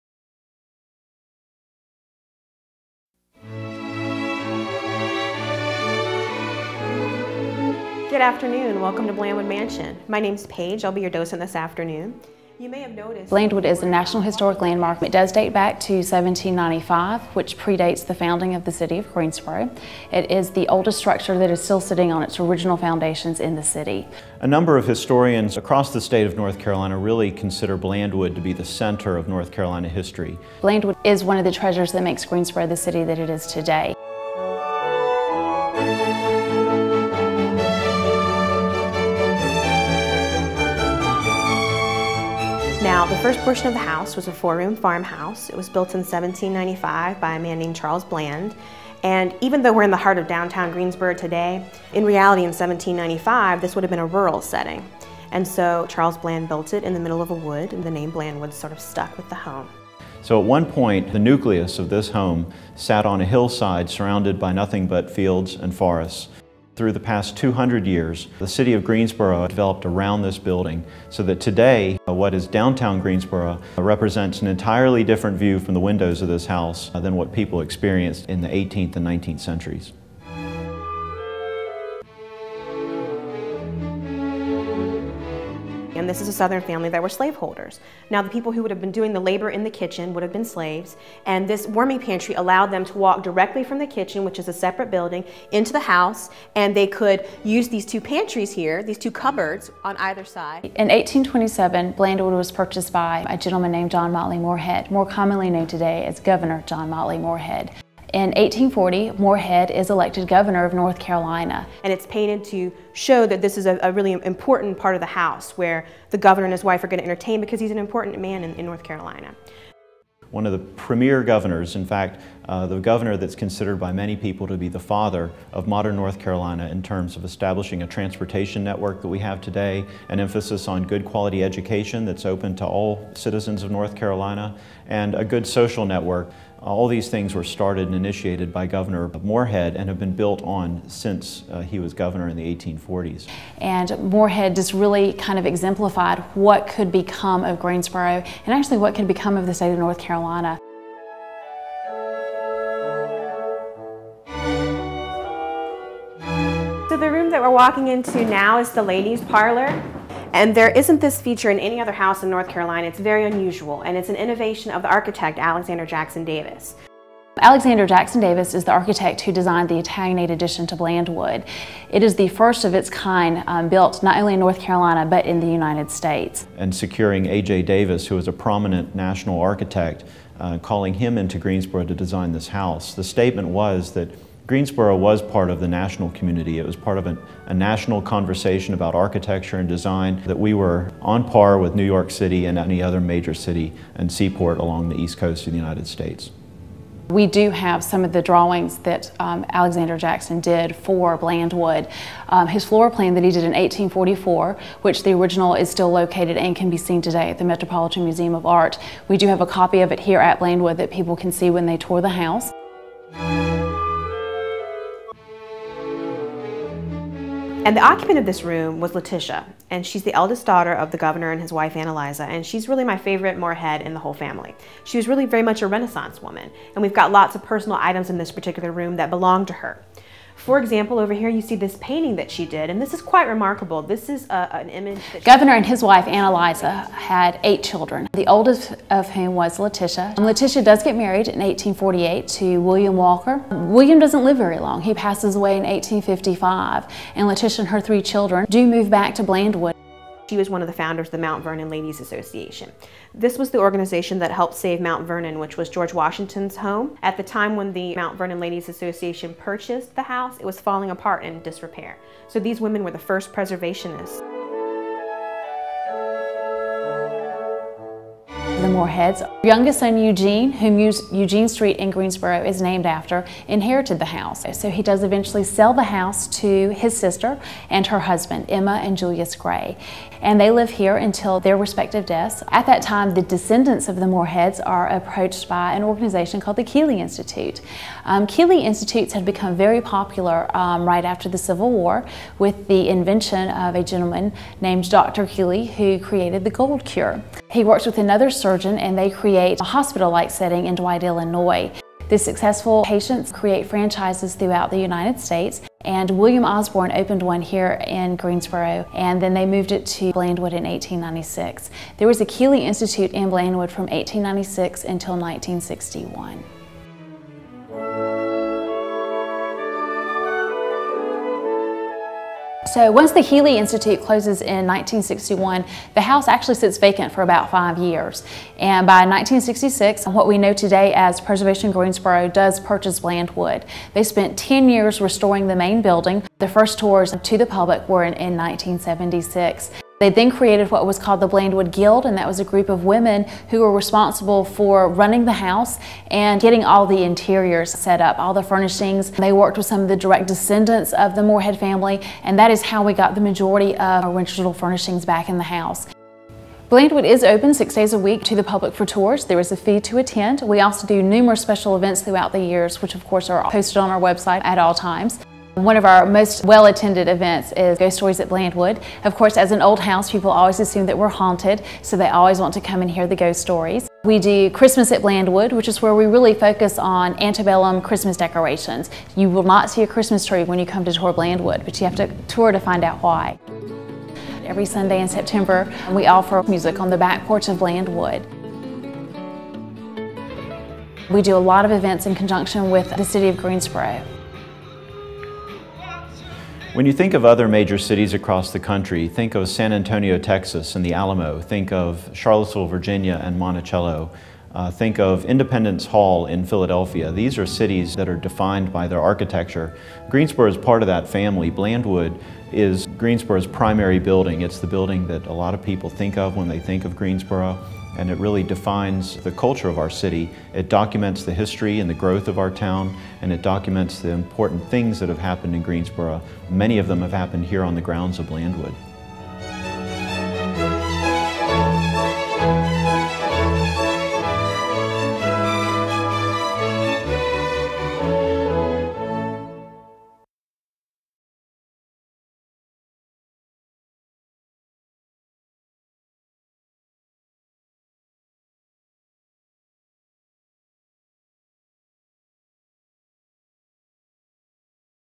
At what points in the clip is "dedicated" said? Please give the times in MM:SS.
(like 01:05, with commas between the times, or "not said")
not said.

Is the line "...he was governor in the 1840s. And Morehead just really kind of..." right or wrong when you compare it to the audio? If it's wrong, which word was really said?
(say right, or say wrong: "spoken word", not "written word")
right.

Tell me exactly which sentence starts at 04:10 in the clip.
She was one of the founders of the Mount Vernon Ladies Association.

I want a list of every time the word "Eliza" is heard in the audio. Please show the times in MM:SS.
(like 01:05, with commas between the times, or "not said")
03:41, 03:56.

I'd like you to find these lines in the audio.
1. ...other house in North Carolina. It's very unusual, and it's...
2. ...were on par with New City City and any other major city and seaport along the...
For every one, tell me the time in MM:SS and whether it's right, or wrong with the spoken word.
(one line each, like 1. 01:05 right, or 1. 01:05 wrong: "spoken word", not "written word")
1. 02:41 right
2. 03:10 wrong: "York", not "City".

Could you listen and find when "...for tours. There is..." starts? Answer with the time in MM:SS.
05:58.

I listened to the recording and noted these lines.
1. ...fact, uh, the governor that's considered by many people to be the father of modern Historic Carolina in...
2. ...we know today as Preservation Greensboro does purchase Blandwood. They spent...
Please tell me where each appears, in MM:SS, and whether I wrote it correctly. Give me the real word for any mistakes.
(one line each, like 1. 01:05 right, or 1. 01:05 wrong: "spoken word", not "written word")
1. 02:01 wrong: "North", not "Historic"
2. 05:30 right.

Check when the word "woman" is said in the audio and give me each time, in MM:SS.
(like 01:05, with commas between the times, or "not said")
03:46.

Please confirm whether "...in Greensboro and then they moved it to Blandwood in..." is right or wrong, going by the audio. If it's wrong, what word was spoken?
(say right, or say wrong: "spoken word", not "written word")
right.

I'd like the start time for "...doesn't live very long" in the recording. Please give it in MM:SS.
04:03.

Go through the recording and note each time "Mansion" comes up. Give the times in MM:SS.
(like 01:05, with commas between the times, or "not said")
00:09.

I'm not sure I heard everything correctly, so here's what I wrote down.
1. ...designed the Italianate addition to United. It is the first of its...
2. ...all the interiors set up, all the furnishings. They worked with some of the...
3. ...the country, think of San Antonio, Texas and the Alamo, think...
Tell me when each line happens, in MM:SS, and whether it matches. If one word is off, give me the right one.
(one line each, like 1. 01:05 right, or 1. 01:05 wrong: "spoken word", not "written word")
1. 02:49 wrong: "Blandwood", not "United"
2. 05:46 right
3. 06:38 right.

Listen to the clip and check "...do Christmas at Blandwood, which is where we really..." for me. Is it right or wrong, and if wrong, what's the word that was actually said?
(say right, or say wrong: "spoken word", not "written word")
right.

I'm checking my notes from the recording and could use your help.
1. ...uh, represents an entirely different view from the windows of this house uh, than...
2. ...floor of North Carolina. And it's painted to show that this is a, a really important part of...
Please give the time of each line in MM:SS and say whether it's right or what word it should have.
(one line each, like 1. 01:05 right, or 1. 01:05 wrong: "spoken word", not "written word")
1. 01:13 right
2. 01:50 wrong: "governor", not "floor".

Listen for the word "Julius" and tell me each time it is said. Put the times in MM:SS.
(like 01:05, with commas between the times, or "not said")
04:38.